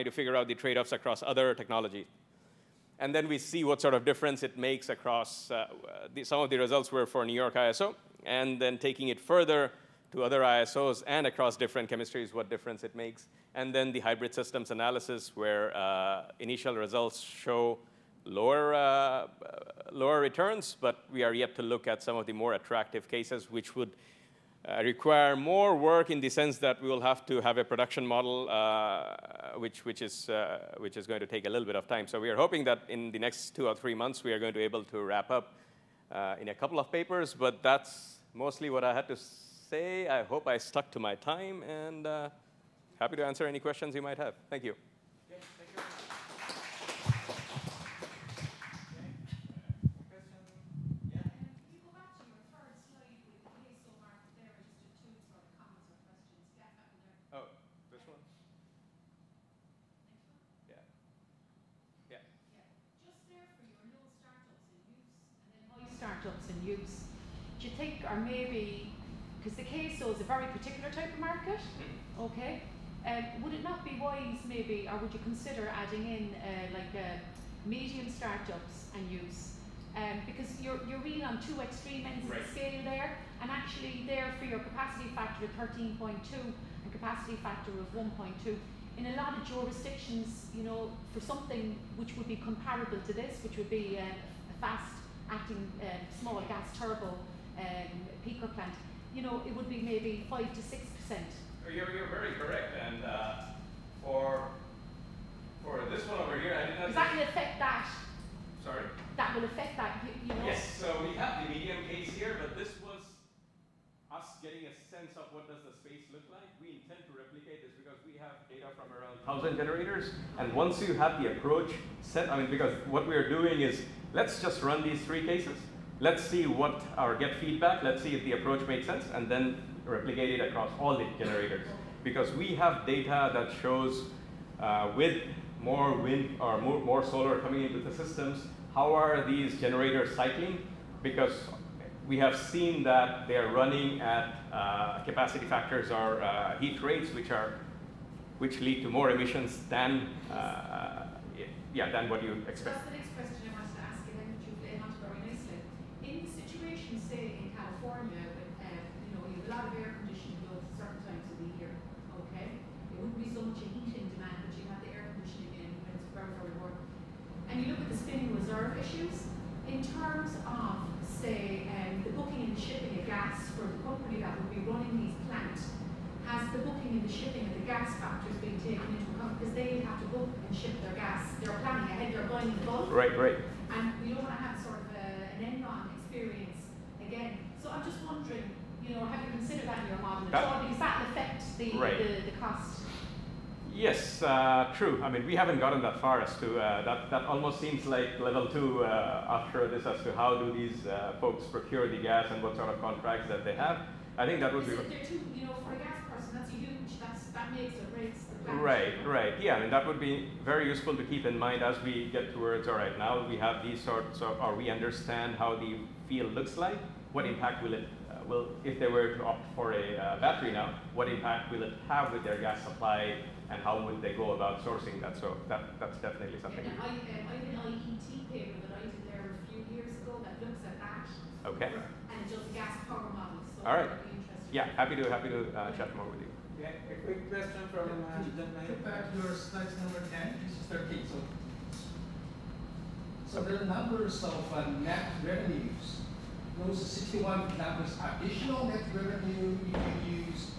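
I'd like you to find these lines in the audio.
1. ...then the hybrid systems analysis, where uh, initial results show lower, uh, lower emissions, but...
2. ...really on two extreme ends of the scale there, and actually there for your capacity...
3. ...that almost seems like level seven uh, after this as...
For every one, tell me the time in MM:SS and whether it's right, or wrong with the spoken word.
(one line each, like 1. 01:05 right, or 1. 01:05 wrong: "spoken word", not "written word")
1. 00:13 wrong: "returns", not "emissions"
2. 01:20 right
3. 03:17 wrong: "two", not "seven".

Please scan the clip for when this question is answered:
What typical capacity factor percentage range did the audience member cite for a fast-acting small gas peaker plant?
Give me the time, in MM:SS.
01:40.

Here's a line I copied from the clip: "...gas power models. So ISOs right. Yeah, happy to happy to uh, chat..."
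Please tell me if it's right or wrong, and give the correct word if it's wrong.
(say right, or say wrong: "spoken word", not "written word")
wrong: "All", not "ISOs".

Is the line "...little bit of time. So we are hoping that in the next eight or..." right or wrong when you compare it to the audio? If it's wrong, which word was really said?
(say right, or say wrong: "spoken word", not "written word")
wrong: "two", not "eight".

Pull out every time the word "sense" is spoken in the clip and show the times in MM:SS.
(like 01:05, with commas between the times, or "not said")
00:26, 01:54, 02:08.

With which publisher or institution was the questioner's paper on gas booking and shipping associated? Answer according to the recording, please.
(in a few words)
IET.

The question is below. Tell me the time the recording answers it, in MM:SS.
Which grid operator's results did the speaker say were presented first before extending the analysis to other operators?
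00:07.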